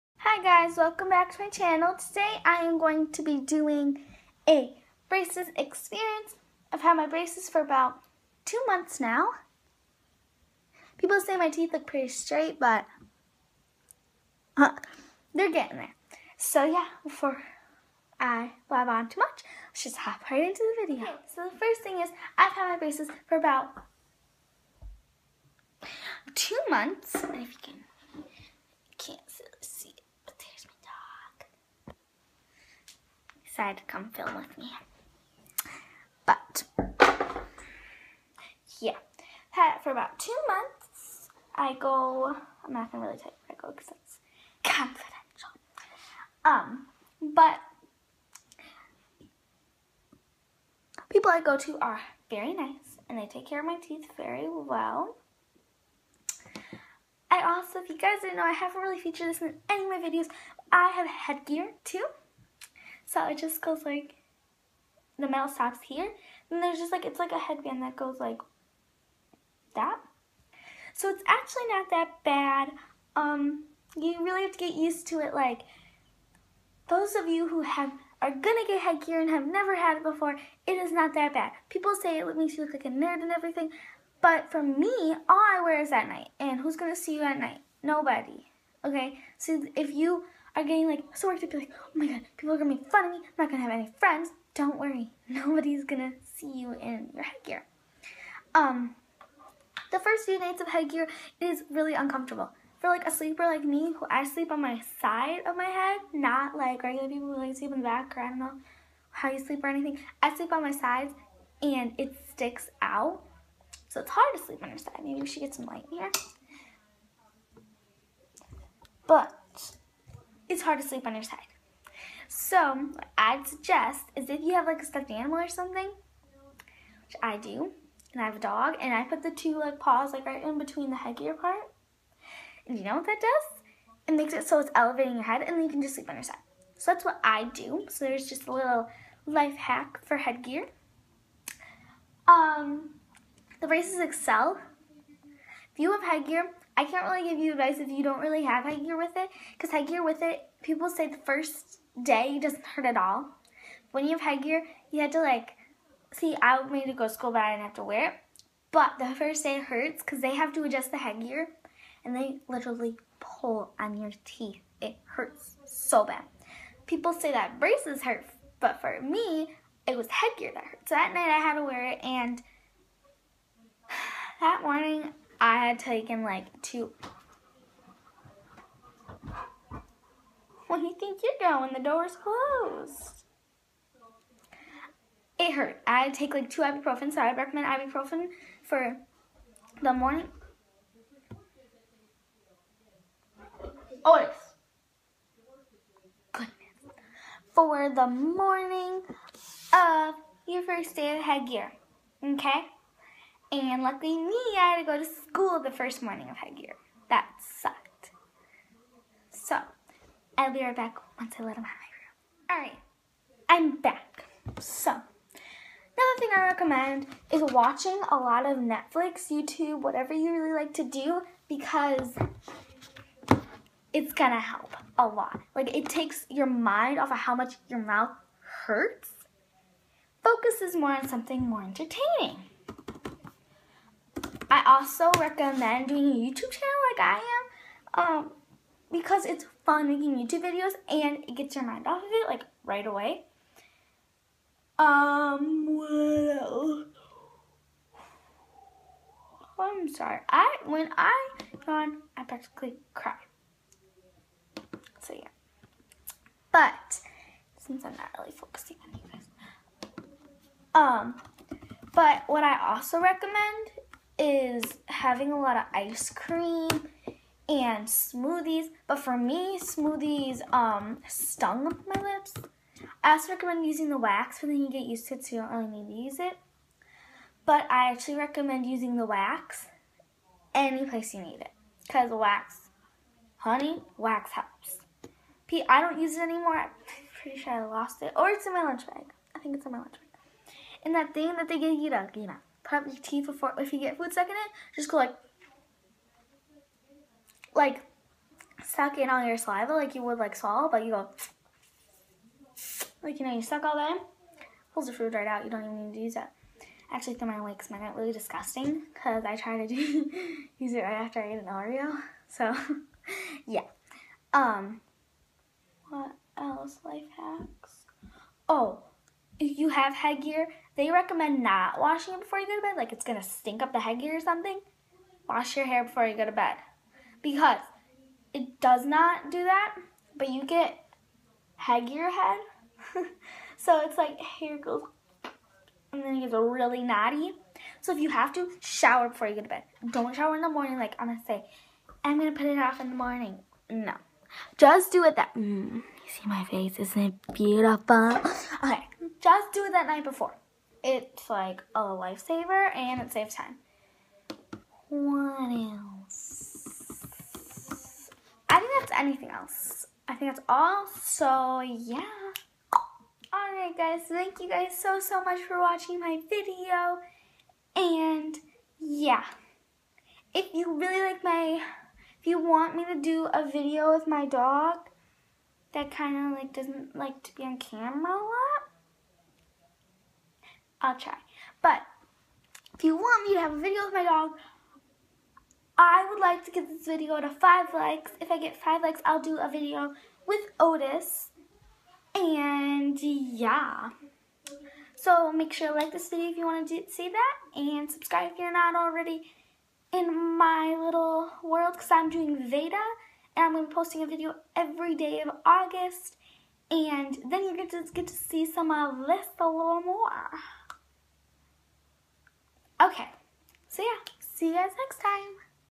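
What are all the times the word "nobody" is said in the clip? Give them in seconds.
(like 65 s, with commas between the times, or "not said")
87 s, 95 s.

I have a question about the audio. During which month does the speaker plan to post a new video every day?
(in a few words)
August.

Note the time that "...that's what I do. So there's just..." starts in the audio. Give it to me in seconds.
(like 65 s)
136 s.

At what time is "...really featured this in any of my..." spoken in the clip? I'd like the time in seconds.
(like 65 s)
58 s.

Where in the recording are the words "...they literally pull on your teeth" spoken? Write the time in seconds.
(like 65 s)
162 s.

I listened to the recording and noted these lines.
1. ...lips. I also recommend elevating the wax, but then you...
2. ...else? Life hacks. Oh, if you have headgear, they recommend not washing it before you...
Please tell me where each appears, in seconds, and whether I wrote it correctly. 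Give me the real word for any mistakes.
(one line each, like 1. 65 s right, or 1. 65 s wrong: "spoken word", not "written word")
1. 272 s wrong: "using", not "elevating"
2. 316 s right.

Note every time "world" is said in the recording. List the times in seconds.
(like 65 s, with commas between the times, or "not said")
401 s.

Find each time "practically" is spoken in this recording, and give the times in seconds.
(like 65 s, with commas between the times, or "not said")
252 s.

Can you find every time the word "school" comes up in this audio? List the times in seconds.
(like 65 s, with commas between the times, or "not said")
157 s, 205 s.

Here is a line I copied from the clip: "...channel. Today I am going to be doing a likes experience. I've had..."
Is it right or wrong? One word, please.
wrong.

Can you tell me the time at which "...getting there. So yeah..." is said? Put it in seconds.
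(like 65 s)
15 s.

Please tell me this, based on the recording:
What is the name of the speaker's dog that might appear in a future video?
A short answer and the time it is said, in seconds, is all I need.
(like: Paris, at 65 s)
Otis, at 390 s.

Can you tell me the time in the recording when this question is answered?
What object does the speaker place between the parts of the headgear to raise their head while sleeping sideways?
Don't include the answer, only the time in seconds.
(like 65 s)
124 s.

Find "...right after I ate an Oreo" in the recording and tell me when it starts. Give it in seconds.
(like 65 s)
310 s.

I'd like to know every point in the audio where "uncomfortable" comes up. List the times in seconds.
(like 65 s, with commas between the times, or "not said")
101 s.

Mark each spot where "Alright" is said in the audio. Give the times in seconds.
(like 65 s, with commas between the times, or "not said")
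212 s, 363 s.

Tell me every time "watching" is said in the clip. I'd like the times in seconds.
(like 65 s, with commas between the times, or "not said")
217 s, 365 s.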